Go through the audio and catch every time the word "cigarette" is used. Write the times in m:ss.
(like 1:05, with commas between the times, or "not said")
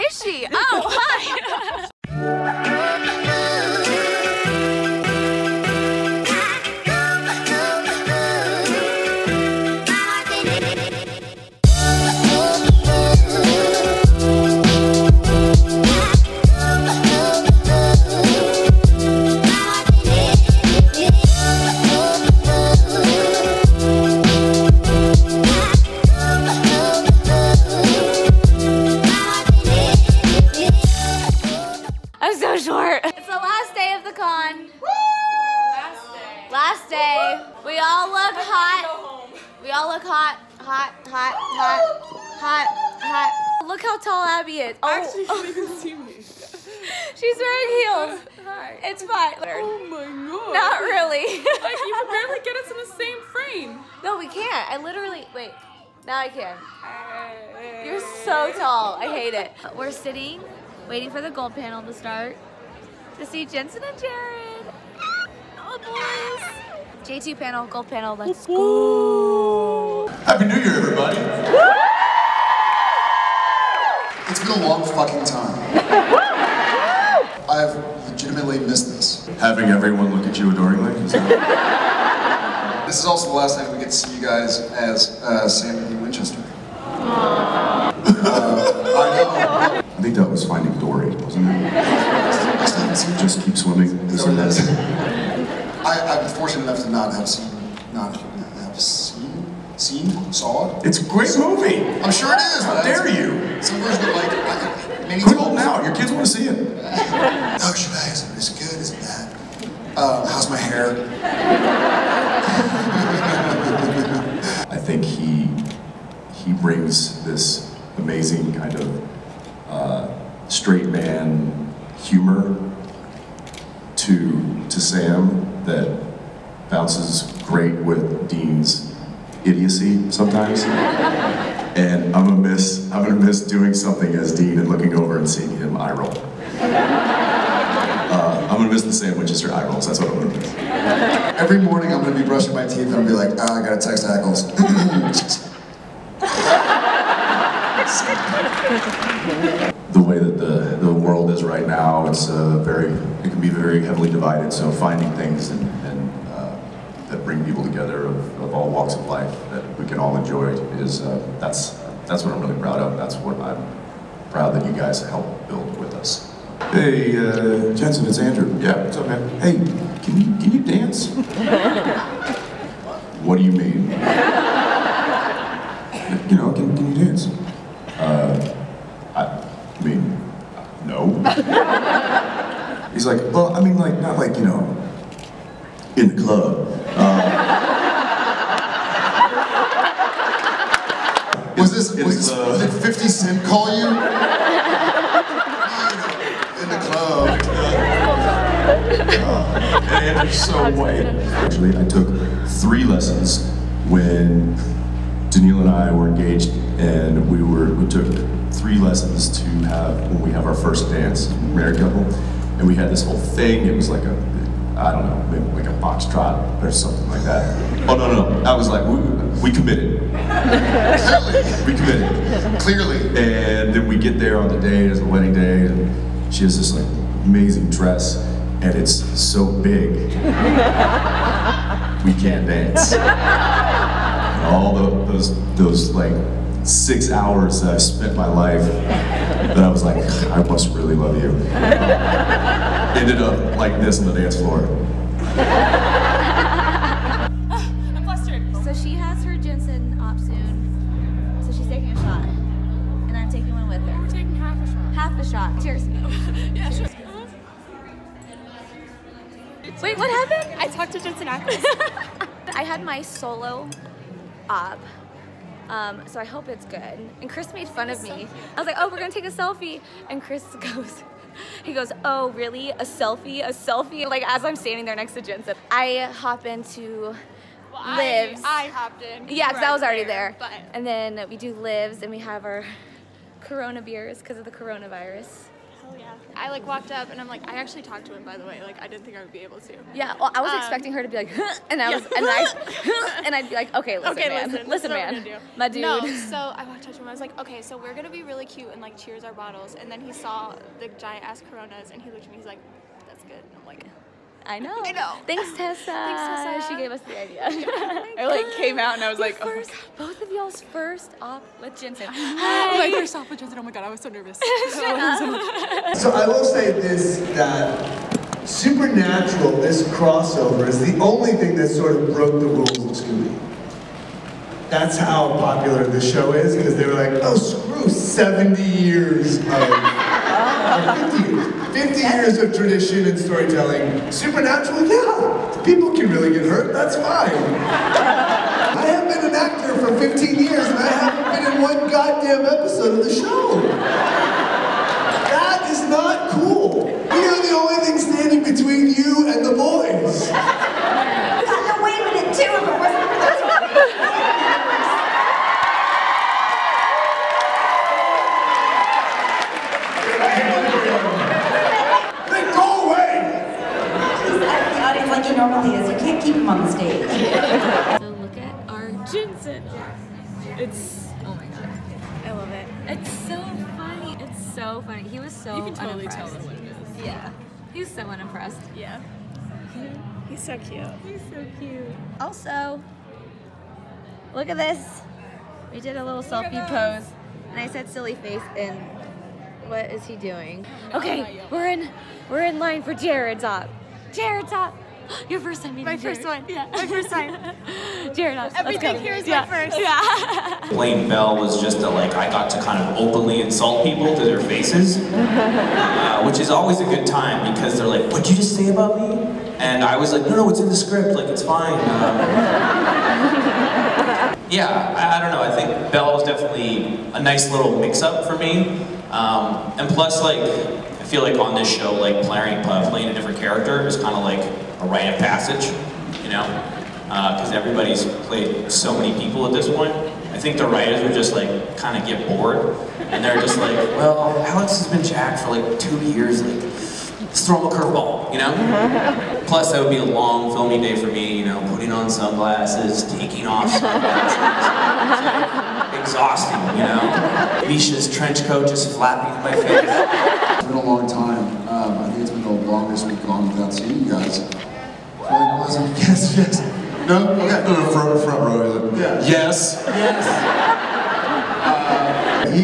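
not said.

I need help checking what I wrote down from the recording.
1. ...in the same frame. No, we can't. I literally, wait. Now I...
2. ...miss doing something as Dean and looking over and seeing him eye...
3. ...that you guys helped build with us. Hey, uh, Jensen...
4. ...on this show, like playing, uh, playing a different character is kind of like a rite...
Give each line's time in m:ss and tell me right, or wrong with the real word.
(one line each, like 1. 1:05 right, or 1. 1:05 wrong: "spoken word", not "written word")
1. 0:52 right
2. 2:13 right
3. 2:44 right
4. 7:01 right.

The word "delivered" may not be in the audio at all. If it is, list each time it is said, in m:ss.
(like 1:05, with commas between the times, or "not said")
not said.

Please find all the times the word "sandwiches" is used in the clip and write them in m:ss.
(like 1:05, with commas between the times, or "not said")
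2:18.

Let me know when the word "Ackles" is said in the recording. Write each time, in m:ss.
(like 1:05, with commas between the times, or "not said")
2:24, 4:21.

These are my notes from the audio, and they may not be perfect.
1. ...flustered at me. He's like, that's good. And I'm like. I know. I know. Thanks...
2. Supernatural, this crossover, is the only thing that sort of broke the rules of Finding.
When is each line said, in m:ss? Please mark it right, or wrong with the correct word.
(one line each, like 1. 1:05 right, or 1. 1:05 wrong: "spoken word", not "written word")
1. 5:02 wrong: "looked", not "flustered"
2. 5:18 wrong: "Scooby", not "Finding".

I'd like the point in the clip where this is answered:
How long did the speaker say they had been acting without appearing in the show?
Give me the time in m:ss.
5:39.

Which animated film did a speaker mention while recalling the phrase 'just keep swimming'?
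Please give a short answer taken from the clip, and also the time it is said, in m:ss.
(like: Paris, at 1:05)
Finding Dory, at 1:30.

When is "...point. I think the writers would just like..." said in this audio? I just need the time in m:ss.
7:09.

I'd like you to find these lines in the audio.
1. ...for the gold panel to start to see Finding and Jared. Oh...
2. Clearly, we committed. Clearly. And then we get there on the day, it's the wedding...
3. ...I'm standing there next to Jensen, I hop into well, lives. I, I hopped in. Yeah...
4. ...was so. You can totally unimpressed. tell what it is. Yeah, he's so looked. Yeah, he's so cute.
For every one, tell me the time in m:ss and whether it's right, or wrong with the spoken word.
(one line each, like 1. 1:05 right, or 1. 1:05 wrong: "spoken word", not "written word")
1. 1:01 wrong: "Jensen", not "Finding"
2. 3:41 right
3. 4:34 right
4. 6:15 wrong: "unimpressed", not "looked".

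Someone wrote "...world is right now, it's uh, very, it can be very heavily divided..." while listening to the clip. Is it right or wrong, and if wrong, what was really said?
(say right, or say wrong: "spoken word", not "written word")
right.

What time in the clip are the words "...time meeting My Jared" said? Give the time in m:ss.
6:35.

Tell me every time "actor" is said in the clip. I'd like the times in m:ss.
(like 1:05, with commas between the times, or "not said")
5:39.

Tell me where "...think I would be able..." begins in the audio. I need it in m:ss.
4:49.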